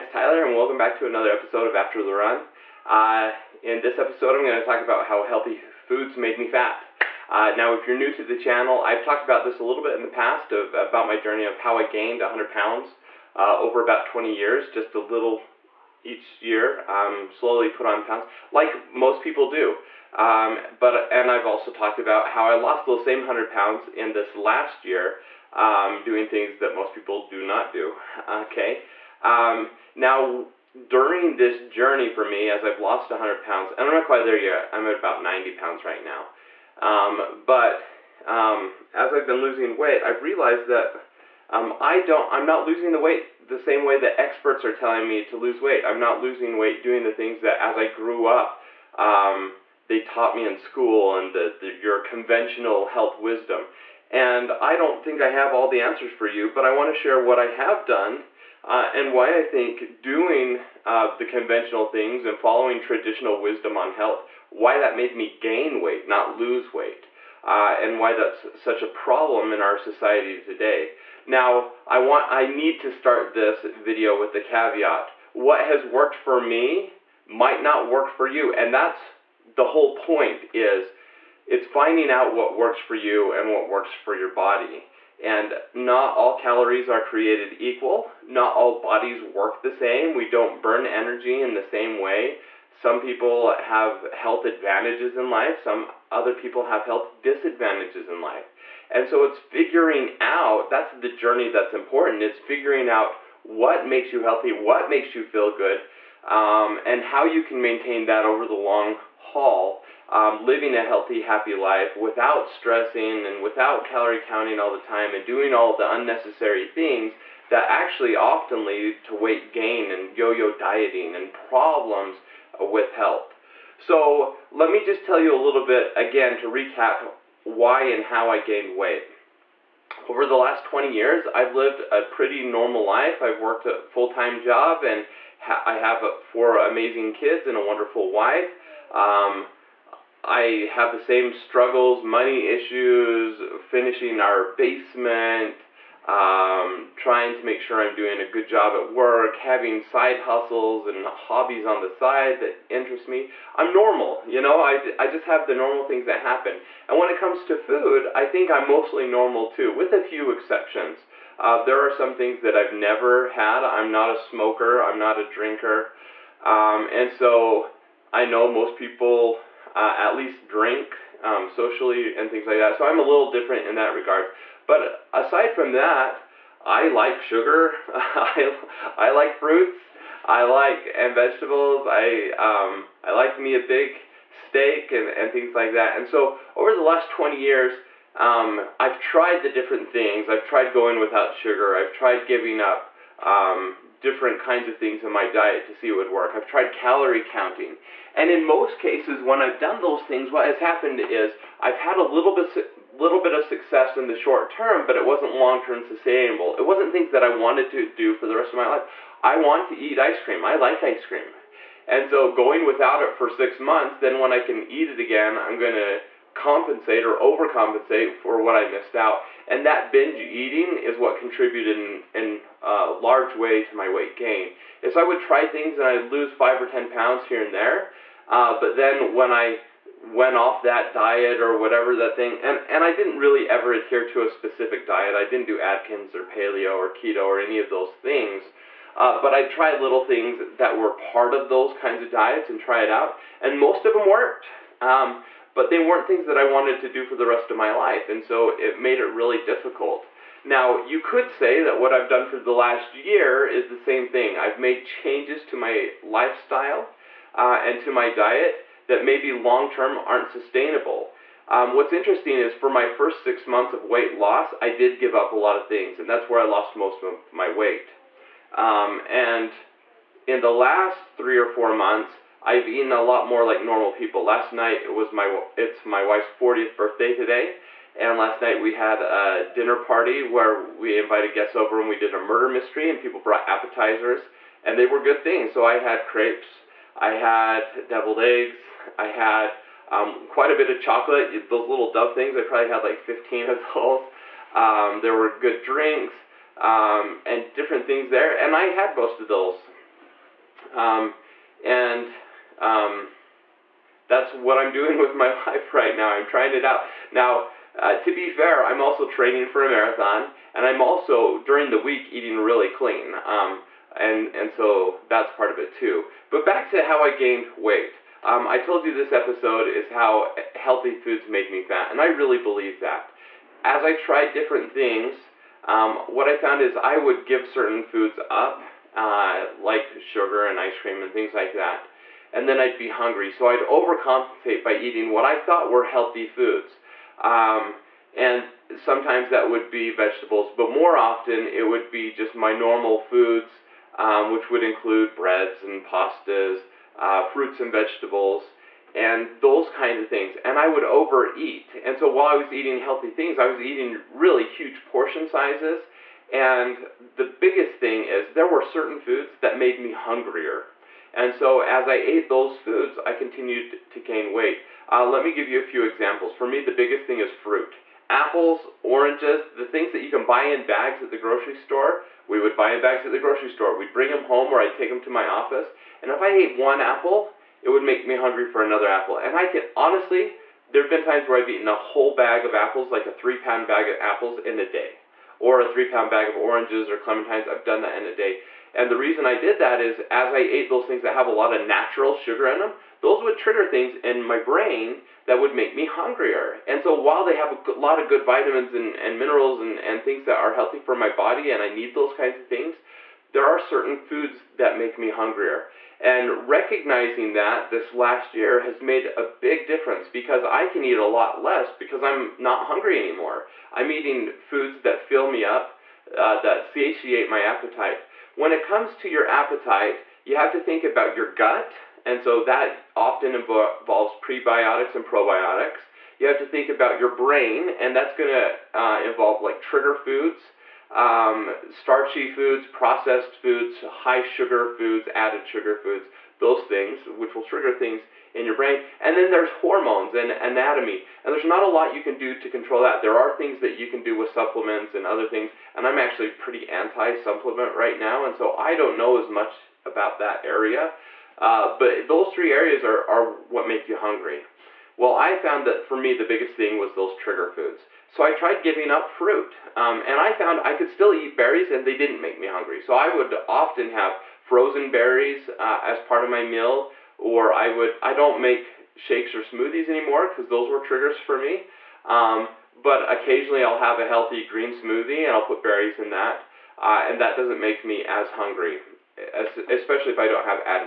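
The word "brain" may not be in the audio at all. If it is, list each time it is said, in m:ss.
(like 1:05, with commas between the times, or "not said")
6:34, 7:07, 7:18.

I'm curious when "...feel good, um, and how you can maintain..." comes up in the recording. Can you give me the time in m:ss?
1:45.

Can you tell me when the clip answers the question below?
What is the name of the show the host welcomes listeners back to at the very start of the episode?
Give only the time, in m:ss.
0:01.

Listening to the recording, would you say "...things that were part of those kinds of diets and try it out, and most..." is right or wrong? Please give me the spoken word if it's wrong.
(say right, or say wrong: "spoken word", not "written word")
right.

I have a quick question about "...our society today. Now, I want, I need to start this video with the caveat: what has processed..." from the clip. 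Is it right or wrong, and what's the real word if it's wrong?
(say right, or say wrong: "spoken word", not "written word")
wrong: "worked", not "processed".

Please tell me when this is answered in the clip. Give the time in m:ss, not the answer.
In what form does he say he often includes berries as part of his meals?
7:44.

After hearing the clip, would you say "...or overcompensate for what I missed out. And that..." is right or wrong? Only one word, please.
right.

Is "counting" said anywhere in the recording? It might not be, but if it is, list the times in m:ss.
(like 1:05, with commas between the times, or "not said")
1:54, 3:17.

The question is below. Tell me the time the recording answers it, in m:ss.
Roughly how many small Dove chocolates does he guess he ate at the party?
4:52.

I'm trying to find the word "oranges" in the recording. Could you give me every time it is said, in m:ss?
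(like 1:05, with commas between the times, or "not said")
6:08, 6:26.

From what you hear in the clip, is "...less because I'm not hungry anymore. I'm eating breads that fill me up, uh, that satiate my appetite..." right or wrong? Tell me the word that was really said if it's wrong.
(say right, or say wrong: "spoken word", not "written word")
wrong: "foods", not "breads".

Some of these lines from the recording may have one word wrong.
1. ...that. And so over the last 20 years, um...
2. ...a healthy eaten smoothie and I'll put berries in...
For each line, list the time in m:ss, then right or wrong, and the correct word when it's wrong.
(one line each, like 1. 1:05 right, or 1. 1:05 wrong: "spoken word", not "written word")
1. 3:05 right
2. 7:53 wrong: "green", not "eaten".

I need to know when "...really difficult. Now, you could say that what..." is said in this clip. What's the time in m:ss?
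4:09.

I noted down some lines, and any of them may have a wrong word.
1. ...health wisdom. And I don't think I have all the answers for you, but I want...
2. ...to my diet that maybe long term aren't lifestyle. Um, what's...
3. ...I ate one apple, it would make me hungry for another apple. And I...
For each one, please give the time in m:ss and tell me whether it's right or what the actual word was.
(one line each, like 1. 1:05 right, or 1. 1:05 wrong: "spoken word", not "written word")
1. 0:52 right
2. 4:17 wrong: "sustainable", not "lifestyle"
3. 6:16 right.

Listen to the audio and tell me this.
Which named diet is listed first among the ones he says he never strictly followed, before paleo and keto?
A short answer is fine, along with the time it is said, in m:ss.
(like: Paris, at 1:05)
Atkins, at 3:55.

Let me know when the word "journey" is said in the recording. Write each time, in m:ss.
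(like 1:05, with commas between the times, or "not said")
0:11, 0:31, 1:41.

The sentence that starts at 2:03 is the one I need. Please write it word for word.
So let me just tell you a little bit again to recap why and how I gained weight.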